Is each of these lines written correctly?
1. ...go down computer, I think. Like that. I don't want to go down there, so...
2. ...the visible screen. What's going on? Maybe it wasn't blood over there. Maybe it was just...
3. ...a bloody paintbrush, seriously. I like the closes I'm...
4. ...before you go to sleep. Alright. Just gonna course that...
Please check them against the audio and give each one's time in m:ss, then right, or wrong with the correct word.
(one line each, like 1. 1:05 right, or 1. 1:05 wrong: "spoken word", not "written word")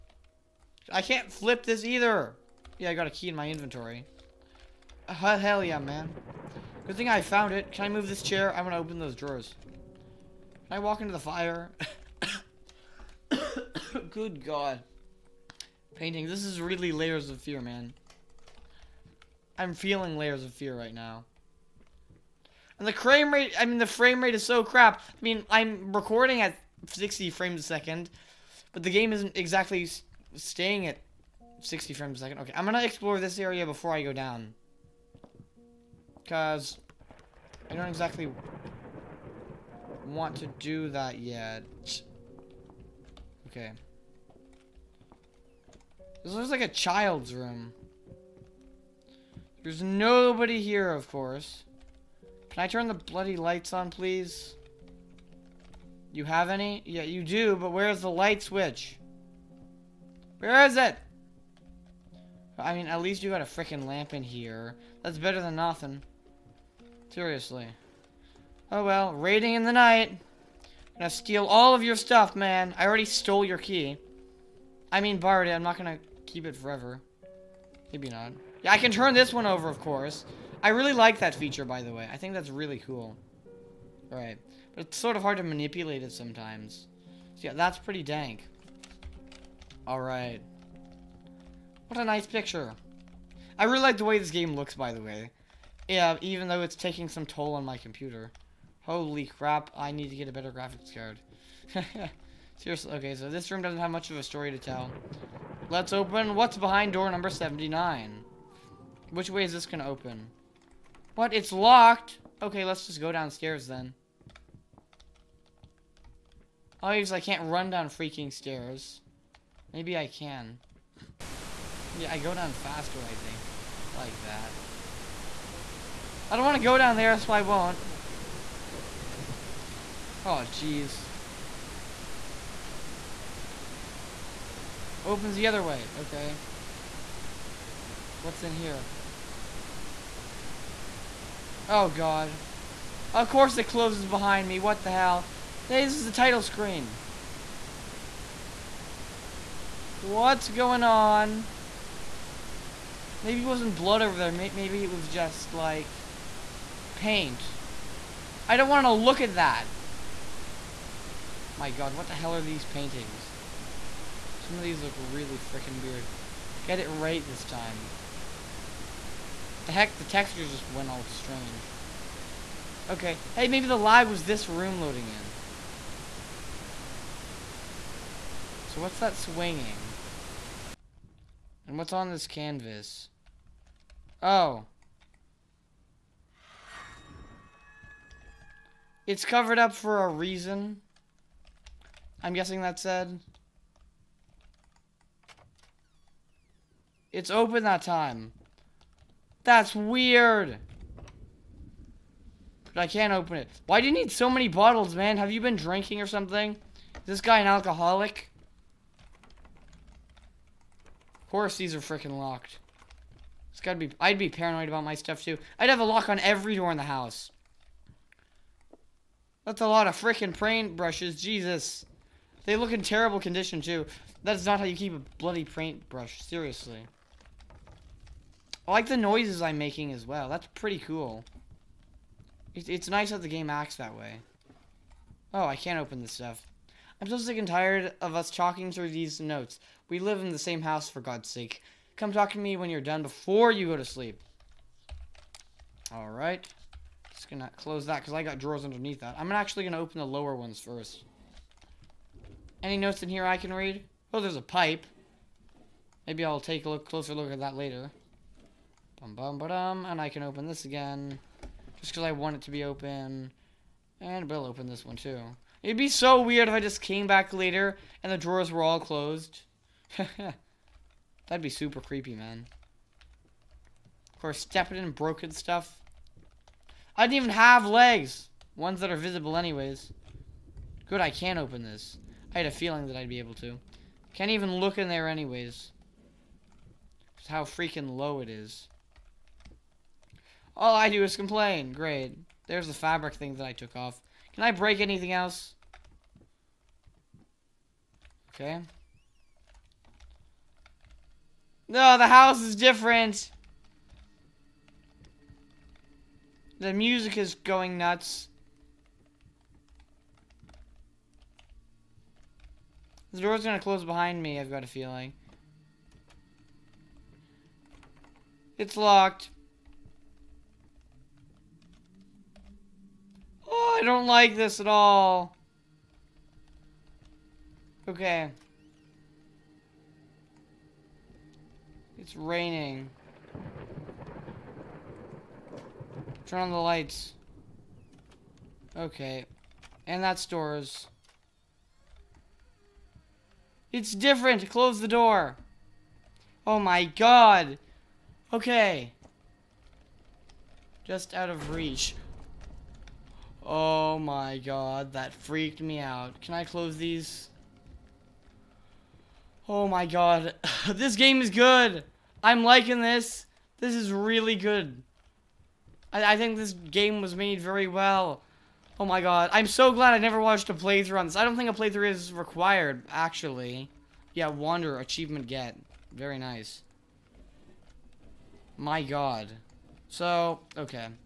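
1. 2:02 wrong: "faster", not "computer"
2. 2:26 wrong: "title", not "visible"
3. 3:44 wrong: "noises", not "closes"
4. 4:03 wrong: "close", not "course".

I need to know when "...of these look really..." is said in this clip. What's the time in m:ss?
2:44.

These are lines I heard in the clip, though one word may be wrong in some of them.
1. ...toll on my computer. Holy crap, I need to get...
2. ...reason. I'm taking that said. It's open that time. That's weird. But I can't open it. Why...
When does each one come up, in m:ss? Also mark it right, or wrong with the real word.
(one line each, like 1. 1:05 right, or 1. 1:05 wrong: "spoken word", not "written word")
1. 1:37 right
2. 3:10 wrong: "guessing", not "taking".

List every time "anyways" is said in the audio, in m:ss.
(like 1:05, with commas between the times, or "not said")
4:39, 4:45.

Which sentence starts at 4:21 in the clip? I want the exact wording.
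Just because I want it to be open.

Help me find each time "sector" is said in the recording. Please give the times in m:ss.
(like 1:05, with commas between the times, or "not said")
not said.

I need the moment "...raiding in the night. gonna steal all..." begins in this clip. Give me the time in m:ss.
1:09.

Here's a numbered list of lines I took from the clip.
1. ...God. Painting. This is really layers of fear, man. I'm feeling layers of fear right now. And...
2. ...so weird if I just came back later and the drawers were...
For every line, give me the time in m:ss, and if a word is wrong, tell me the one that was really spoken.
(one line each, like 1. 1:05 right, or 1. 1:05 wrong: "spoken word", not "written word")
1. 0:14 right
2. 4:25 right.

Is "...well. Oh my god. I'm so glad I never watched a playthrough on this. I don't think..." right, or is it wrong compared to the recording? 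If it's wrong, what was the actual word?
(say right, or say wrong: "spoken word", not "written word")
right.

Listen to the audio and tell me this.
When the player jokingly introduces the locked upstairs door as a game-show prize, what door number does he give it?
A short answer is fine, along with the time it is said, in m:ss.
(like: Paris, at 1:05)
79, at 1:46.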